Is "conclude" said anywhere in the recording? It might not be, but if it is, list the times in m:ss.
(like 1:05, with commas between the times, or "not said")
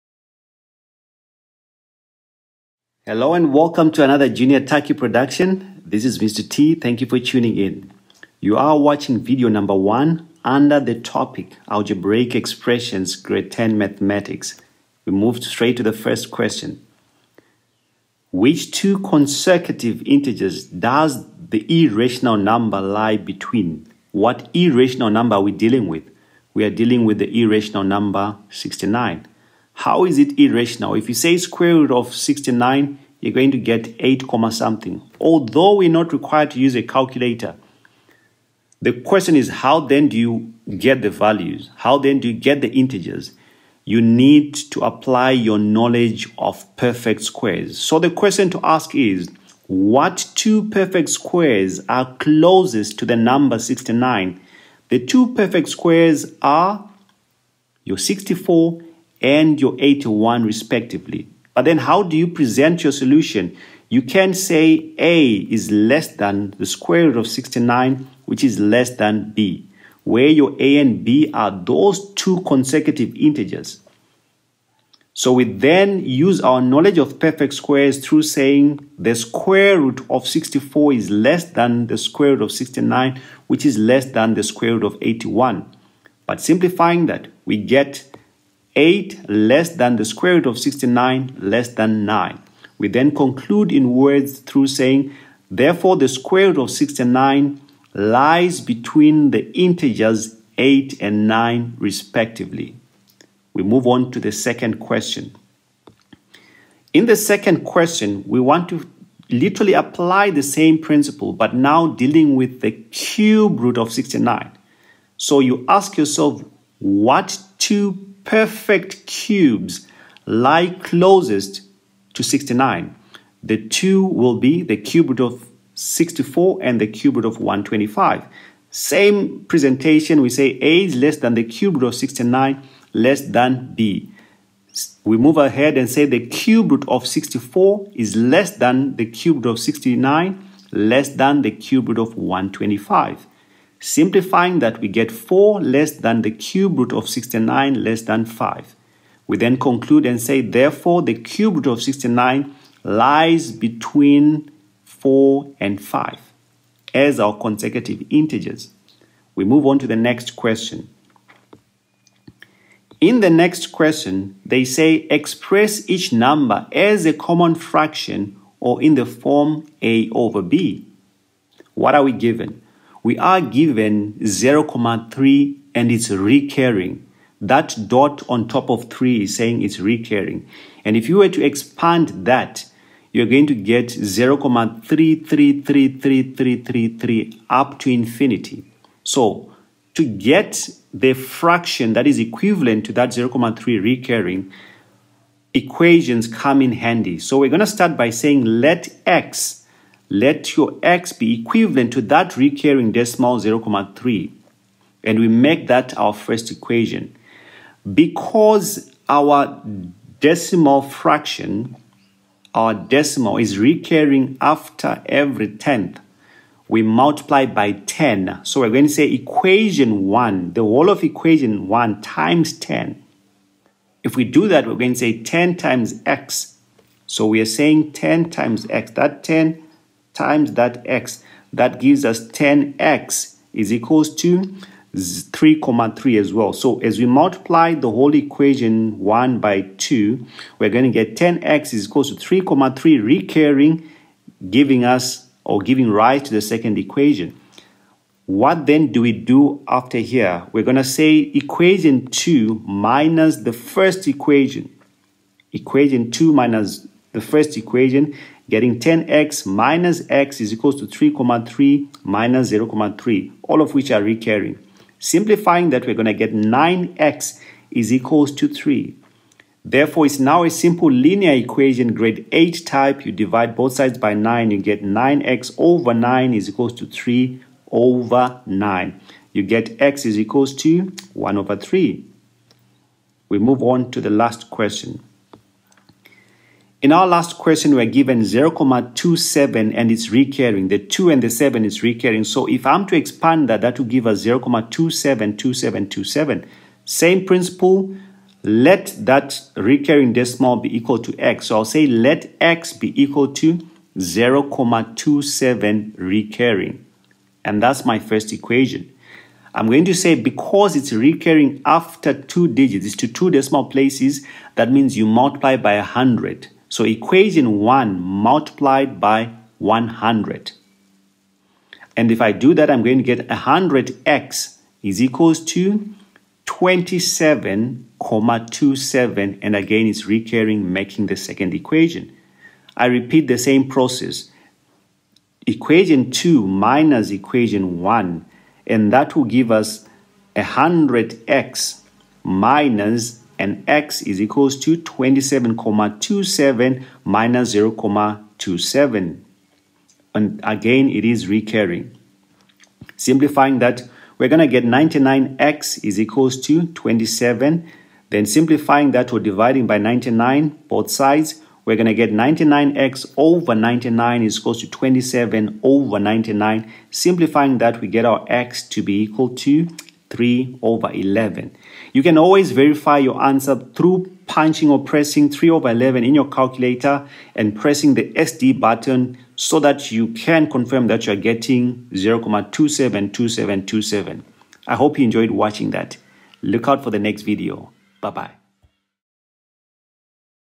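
1:33, 2:29.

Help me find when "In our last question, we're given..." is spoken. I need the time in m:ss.
4:46.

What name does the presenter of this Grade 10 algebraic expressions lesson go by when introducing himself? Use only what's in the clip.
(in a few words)
Mr. T.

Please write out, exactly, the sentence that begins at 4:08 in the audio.
What then do we do after here?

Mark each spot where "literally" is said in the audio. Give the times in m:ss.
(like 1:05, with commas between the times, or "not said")
1:49.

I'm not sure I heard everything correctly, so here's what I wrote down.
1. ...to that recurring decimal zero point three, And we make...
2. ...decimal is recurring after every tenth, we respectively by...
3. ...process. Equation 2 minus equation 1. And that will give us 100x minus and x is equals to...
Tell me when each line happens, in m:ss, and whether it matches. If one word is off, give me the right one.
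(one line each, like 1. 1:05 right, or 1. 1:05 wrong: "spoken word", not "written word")
1. 3:21 right
2. 3:32 wrong: "multiply", not "respectively"
3. 5:33 right.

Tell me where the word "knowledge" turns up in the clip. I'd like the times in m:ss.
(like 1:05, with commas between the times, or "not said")
0:45, 1:16.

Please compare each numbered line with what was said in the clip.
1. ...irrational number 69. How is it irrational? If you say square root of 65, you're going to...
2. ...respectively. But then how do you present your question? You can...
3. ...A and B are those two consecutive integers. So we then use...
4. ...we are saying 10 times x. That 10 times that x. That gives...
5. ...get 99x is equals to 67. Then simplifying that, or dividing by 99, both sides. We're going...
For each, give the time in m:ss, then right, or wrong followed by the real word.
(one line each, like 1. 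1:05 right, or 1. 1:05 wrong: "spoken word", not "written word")
1. 0:27 wrong: "69", not "65"
2. 1:00 wrong: "solution", not "question"
3. 1:10 right
4. 3:47 right
5. 5:54 wrong: "27", not "67".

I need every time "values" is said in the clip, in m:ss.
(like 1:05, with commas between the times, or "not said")
0:41.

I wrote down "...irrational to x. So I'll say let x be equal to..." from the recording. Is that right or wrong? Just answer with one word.
wrong.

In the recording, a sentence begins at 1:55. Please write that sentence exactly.
So you ask yourself, what two perfect cubes lie closest to 69.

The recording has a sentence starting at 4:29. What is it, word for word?
Therefore, it's now a simple linear equation, grade 8 type.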